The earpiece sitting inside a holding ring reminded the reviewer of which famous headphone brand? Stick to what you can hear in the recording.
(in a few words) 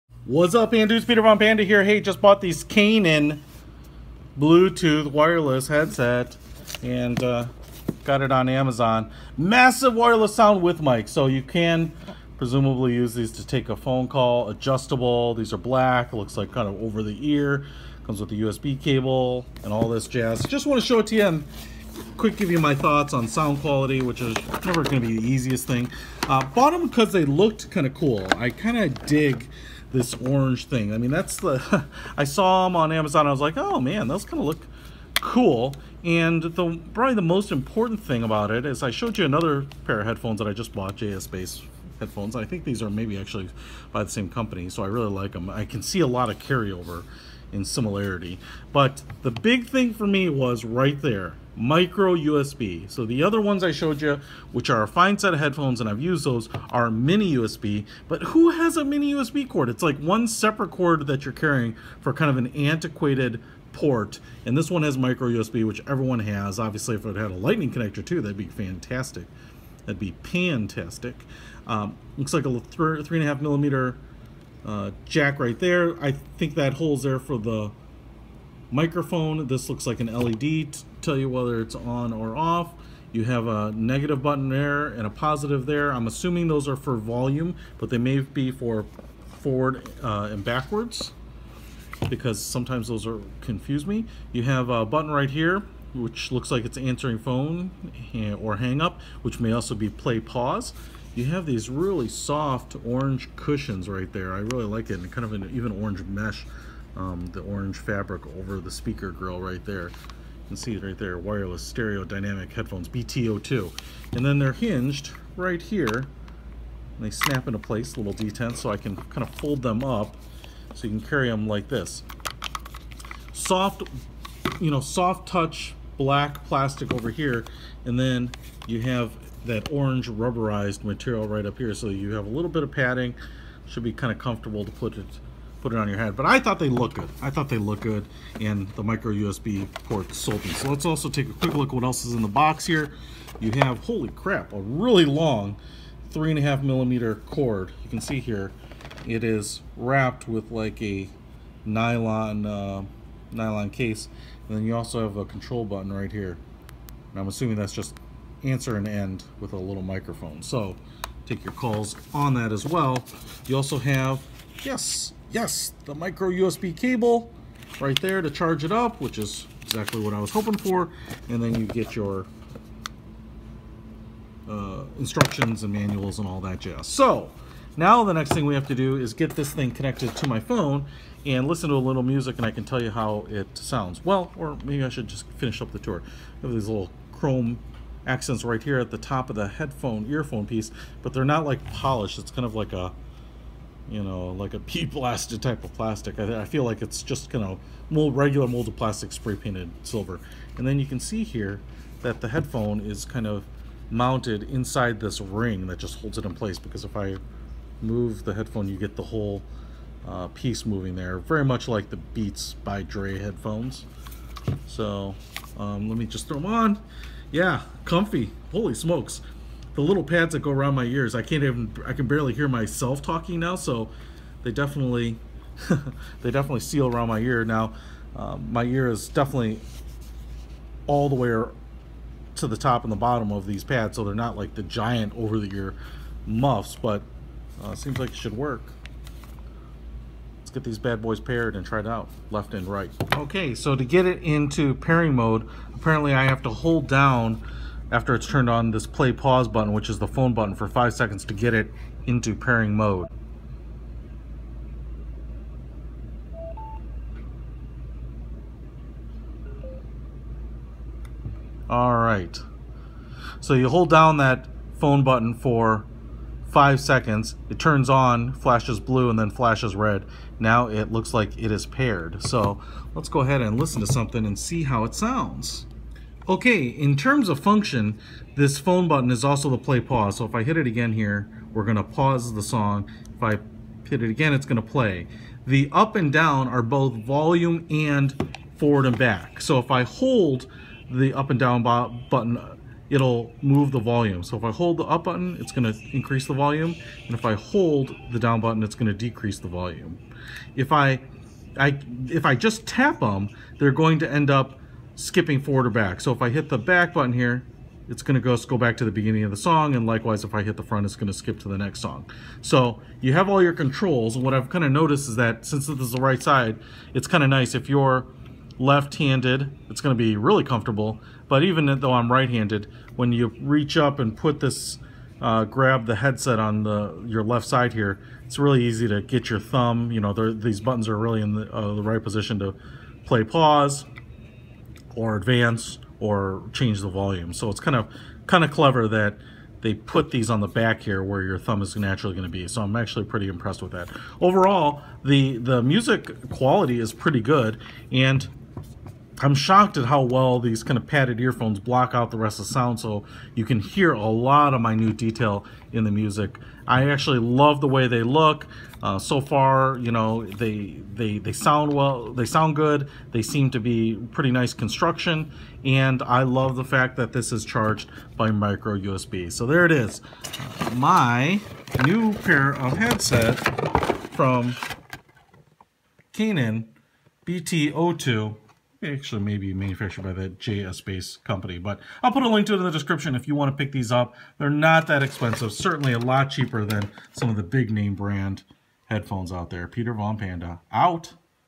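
Beats by Dre.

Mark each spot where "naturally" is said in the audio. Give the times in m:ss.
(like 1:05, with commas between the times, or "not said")
5:41.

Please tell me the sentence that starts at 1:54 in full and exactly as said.
And then they're hinged right here.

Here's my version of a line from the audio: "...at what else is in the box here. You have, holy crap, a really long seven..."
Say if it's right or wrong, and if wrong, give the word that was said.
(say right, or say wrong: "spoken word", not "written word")
wrong: "three", not "seven".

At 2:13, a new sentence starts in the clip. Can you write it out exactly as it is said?
Should be kind of comfortable to put it put it on your head.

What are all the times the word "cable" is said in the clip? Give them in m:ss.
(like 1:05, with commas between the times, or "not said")
0:18, 2:46.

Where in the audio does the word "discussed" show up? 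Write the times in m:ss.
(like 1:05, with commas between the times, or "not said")
not said.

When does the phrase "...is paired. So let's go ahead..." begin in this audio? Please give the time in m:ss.
4:31.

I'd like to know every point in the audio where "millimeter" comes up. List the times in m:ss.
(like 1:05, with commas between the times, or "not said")
1:13, 2:26.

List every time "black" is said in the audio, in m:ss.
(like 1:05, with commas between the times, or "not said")
0:15, 2:05.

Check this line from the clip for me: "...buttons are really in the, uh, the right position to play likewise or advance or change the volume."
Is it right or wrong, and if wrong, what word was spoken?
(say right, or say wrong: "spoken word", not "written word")
wrong: "pause", not "likewise".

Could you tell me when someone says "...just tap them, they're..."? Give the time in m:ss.
5:02.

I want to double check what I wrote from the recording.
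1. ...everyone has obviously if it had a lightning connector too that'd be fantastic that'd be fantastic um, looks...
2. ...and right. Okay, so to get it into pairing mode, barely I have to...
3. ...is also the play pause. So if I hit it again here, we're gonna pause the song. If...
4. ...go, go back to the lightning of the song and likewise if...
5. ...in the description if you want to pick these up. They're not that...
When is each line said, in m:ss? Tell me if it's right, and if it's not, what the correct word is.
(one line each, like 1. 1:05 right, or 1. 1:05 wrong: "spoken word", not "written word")
1. 1:05 right
2. 4:02 wrong: "apparently", not "barely"
3. 4:39 right
4. 5:08 wrong: "beginning", not "lightning"
5. 6:22 right.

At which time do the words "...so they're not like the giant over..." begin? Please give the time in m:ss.
3:53.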